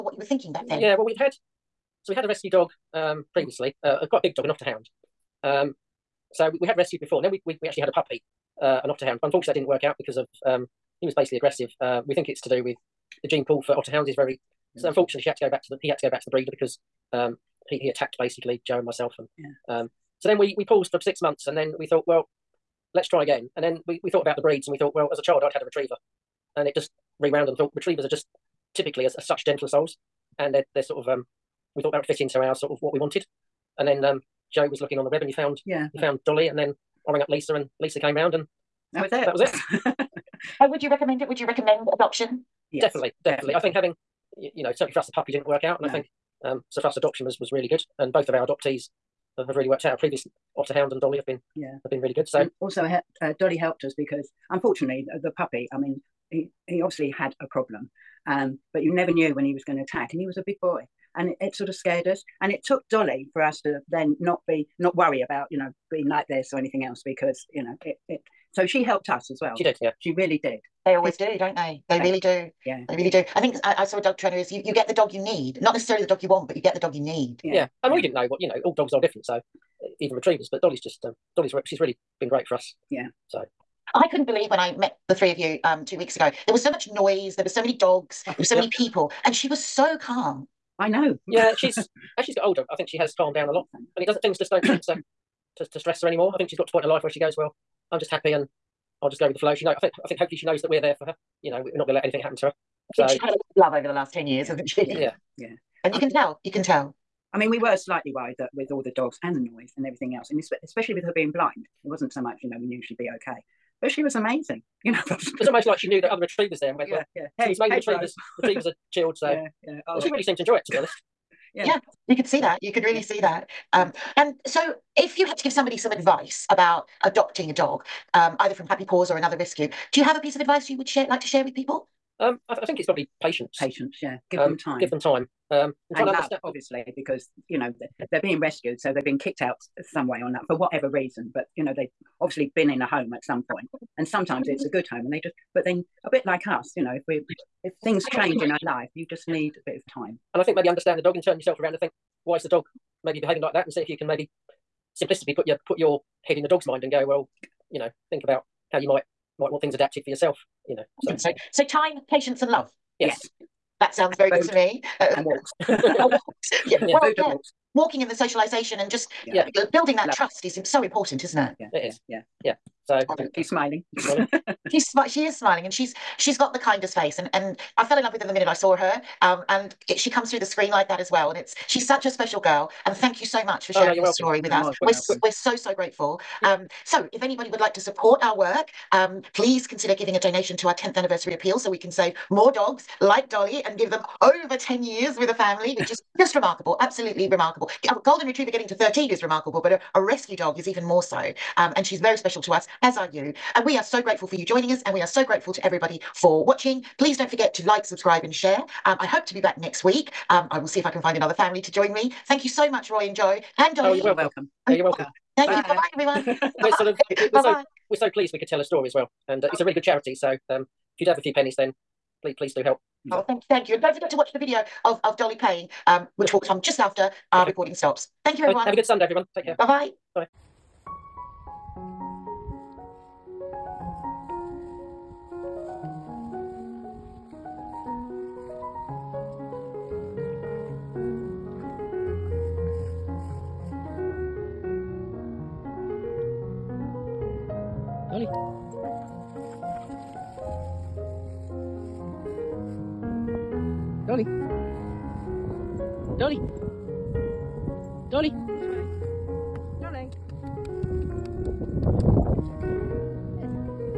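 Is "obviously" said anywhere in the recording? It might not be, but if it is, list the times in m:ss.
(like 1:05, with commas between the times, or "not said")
0:56, 2:16, 2:22.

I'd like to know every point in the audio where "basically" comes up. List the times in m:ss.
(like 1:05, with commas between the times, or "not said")
0:11, 0:18.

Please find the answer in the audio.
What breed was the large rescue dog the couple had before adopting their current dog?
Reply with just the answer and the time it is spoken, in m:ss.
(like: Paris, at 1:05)
Otterhound, at 0:04.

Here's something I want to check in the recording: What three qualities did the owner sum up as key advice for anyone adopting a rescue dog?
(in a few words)
Time, patience, and love.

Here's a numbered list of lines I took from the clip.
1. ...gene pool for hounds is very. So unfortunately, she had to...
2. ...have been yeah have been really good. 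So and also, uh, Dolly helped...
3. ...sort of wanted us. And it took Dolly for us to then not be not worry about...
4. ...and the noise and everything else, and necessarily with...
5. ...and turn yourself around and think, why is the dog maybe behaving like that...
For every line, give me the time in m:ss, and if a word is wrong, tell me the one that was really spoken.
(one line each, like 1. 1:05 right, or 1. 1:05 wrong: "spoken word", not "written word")
1. 0:13 right
2. 0:51 right
3. 1:01 wrong: "scared", not "wanted"
4. 1:49 wrong: "especially", not "necessarily"
5. 2:31 right.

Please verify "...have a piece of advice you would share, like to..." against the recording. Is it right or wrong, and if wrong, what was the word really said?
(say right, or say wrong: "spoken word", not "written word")
right.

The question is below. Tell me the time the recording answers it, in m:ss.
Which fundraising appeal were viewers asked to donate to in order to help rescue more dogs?
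3:10.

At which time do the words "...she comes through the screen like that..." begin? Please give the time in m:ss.
2:59.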